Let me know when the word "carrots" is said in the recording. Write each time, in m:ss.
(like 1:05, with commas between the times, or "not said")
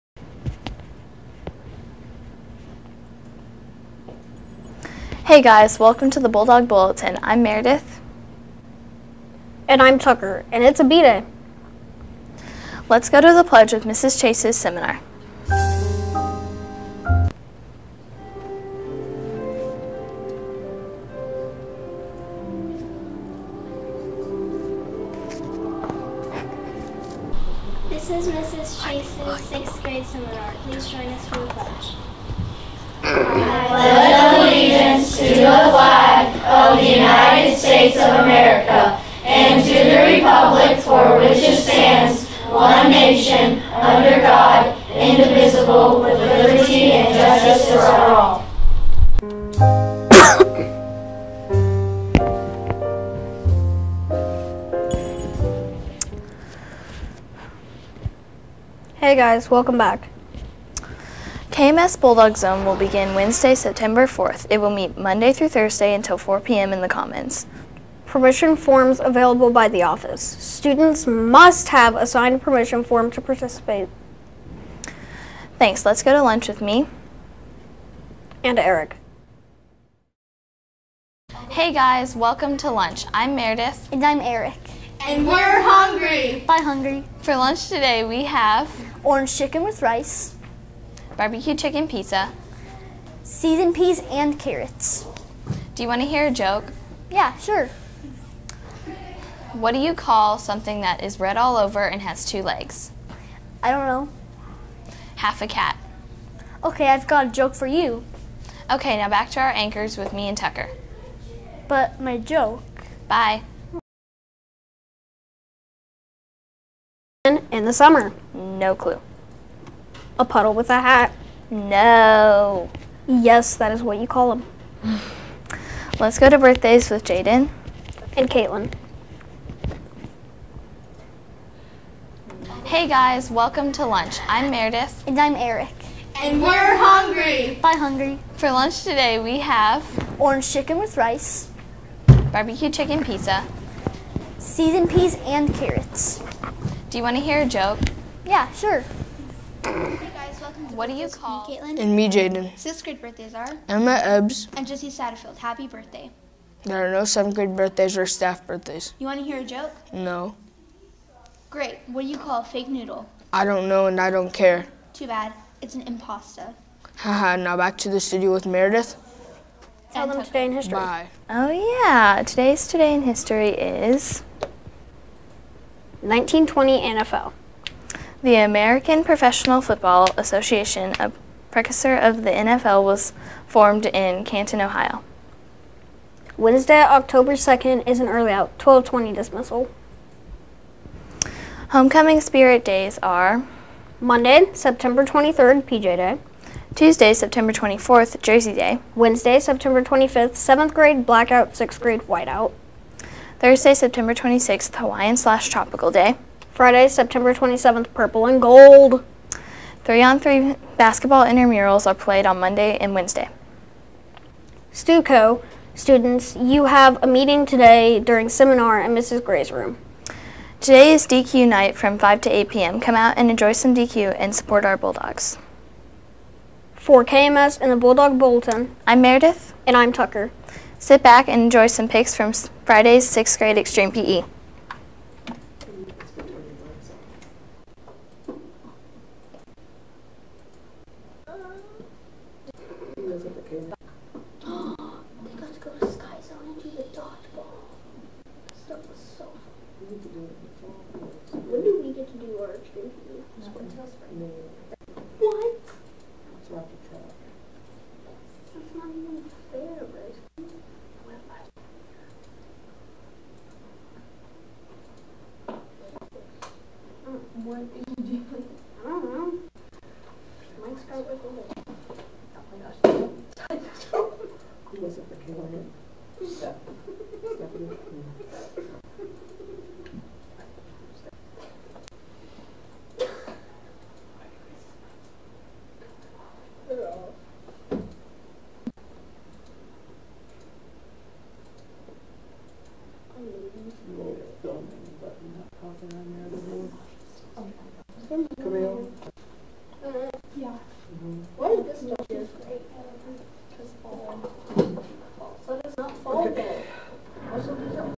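1:34, 2:25.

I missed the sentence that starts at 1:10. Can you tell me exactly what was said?
Students must have a signed permission form to participate.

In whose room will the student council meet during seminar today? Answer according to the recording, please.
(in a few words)
Mrs. Gray's room.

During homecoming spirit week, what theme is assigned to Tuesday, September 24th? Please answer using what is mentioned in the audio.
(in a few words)
Jersey Day.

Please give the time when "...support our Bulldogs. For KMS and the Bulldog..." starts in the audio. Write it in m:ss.
3:44.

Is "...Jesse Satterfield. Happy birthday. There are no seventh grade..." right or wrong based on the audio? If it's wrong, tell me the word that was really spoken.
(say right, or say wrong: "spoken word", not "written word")
right.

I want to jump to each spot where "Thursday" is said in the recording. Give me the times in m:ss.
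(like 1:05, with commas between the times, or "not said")
1:05, 3:23.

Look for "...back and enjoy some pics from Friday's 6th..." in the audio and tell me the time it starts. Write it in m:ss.
3:51.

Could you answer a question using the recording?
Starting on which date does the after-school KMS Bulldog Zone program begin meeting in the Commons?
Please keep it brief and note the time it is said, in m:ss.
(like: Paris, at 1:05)
Wednesday, September 4th, at 1:03.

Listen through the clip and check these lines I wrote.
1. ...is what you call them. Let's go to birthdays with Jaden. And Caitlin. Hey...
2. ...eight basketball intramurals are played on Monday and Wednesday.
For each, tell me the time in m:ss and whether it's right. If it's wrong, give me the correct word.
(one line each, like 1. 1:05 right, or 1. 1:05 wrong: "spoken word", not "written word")
1. 2:03 right
2. 3:30 wrong: "three", not "eight".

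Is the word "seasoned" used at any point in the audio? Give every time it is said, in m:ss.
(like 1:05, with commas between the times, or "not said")
1:33, 2:24.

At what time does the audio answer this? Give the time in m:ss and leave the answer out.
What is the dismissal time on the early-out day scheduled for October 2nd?
3:08.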